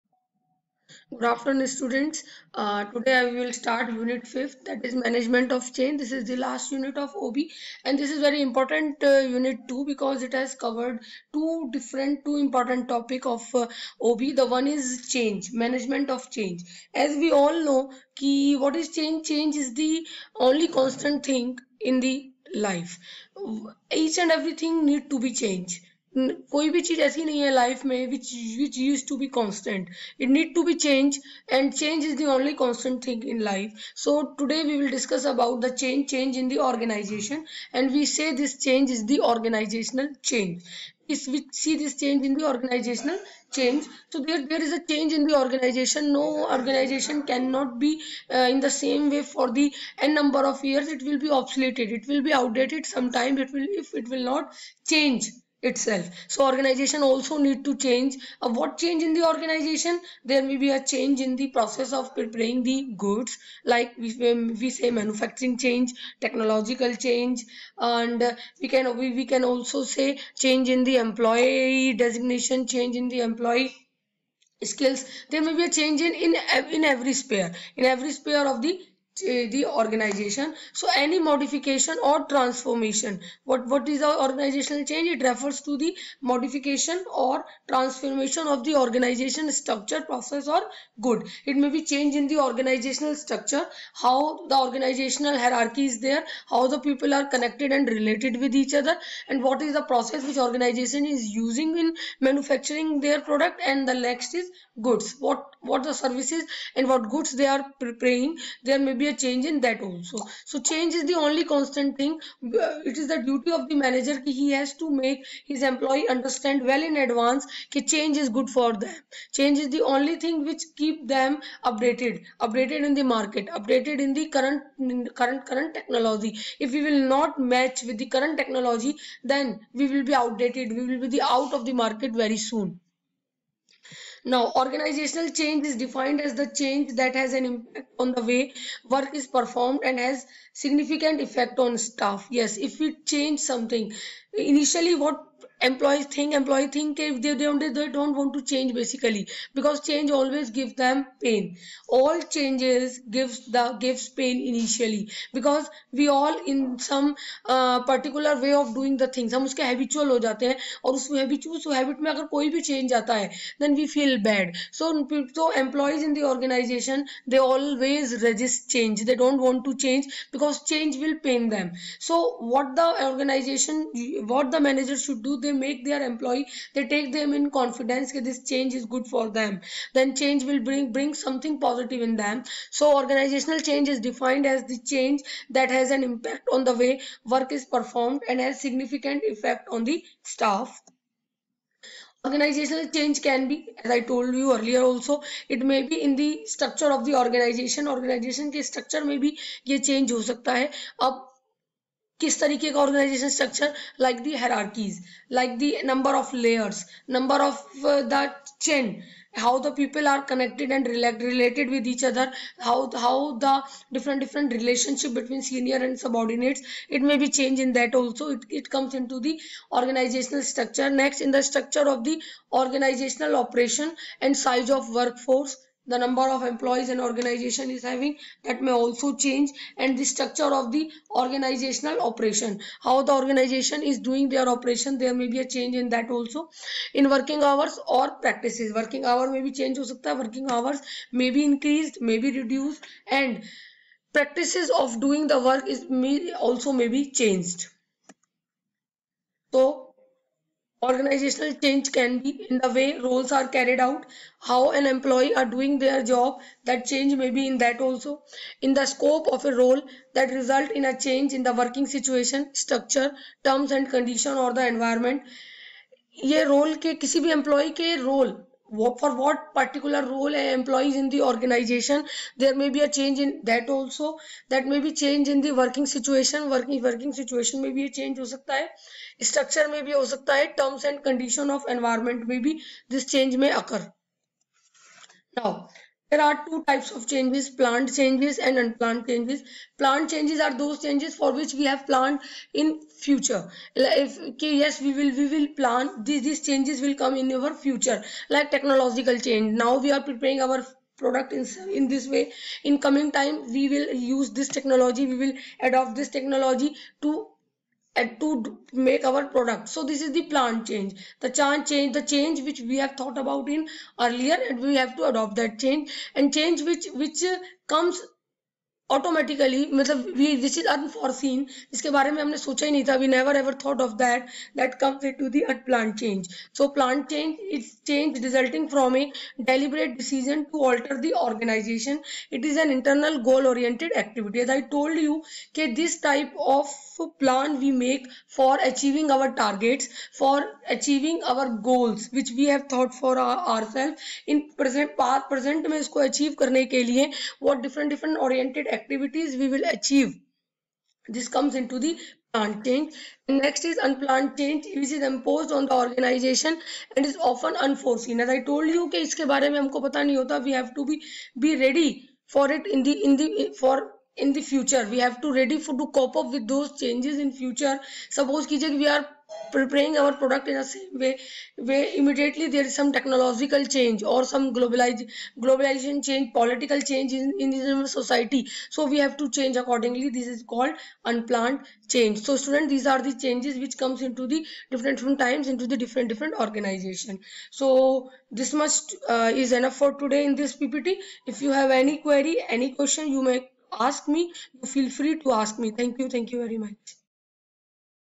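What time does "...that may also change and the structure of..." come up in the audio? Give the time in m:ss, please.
3:48.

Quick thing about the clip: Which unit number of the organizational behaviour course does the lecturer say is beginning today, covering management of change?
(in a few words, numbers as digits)
5th.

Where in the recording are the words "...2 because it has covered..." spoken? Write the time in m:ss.
0:09.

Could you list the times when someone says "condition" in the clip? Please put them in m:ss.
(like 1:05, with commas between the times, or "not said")
4:23, 4:41.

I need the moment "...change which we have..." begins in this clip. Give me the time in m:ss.
5:12.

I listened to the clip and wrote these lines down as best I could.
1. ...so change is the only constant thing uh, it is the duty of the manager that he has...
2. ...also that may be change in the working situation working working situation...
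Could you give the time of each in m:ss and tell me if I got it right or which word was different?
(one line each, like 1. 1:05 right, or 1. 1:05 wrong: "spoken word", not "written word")
1. 1:50 right
2. 4:33 right.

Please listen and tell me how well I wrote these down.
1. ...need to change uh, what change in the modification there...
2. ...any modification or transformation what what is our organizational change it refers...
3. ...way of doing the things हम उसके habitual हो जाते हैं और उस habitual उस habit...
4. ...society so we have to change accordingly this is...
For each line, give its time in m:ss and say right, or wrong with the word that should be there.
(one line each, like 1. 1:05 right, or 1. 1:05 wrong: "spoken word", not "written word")
1. 0:57 wrong: "organization", not "modification"
2. 1:20 right
3. 2:38 right
4. 6:17 right.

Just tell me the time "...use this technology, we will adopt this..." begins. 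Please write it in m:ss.
5:04.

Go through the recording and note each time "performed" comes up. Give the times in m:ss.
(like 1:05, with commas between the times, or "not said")
2:19, 3:07.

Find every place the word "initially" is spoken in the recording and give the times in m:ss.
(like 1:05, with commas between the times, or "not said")
2:24, 2:34.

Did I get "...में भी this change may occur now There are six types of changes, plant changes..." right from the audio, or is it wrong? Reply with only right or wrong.
wrong.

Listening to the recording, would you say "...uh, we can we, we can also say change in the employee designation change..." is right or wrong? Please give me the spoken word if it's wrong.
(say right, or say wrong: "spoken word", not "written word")
right.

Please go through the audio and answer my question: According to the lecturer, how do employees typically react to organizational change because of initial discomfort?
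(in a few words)
resist change.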